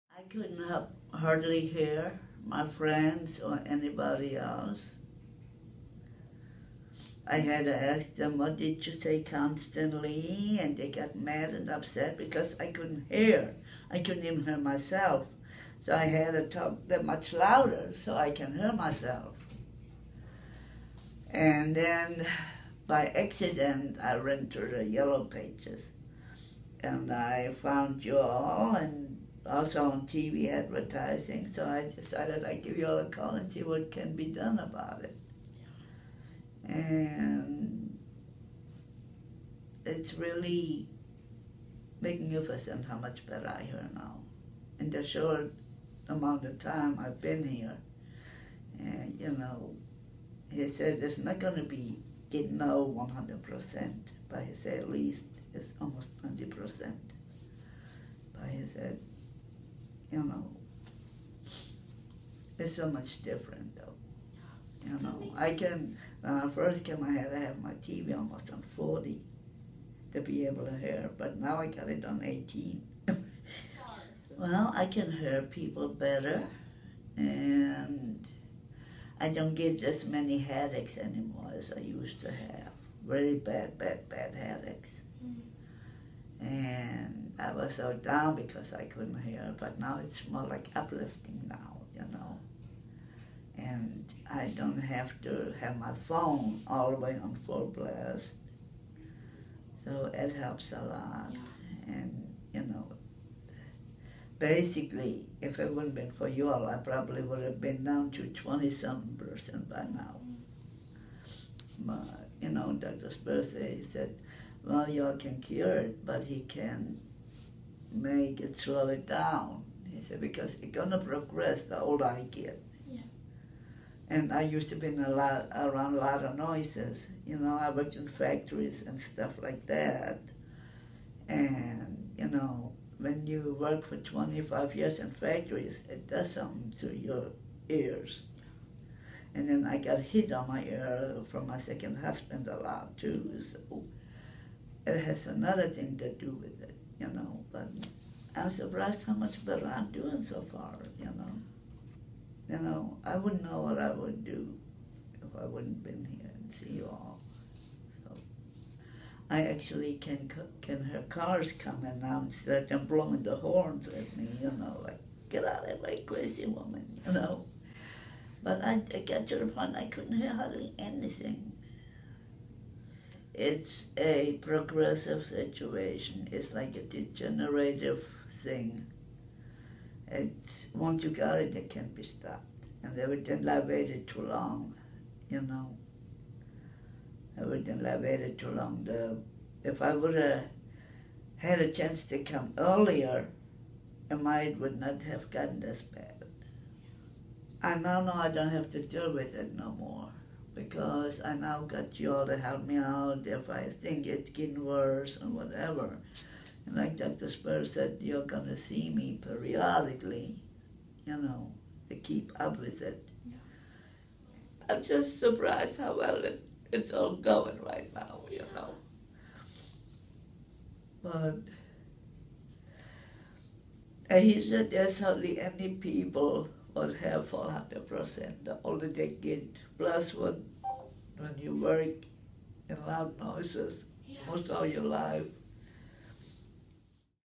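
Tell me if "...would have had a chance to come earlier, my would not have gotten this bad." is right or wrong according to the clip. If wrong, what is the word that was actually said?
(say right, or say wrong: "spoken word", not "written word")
right.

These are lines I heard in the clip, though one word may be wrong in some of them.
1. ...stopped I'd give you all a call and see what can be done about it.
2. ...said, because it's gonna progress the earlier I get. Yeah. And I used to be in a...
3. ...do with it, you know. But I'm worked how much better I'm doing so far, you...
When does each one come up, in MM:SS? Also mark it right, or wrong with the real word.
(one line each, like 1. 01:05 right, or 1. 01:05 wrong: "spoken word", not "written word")
1. 00:31 wrong: "decided", not "stopped"
2. 02:00 wrong: "older", not "earlier"
3. 02:26 wrong: "surprised", not "worked".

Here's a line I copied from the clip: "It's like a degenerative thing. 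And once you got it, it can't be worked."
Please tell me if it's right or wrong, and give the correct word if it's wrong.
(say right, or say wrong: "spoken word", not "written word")
wrong: "stopped", not "worked".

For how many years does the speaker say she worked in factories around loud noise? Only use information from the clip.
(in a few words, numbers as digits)
25.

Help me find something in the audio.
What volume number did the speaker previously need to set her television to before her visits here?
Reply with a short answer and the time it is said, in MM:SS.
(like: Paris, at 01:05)
40, at 01:08.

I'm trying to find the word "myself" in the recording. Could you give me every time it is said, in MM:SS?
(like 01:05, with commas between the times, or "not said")
00:14, 00:18.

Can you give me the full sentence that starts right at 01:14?
well, I can hear people better, and I don't get as many headaches anymore as I used to have.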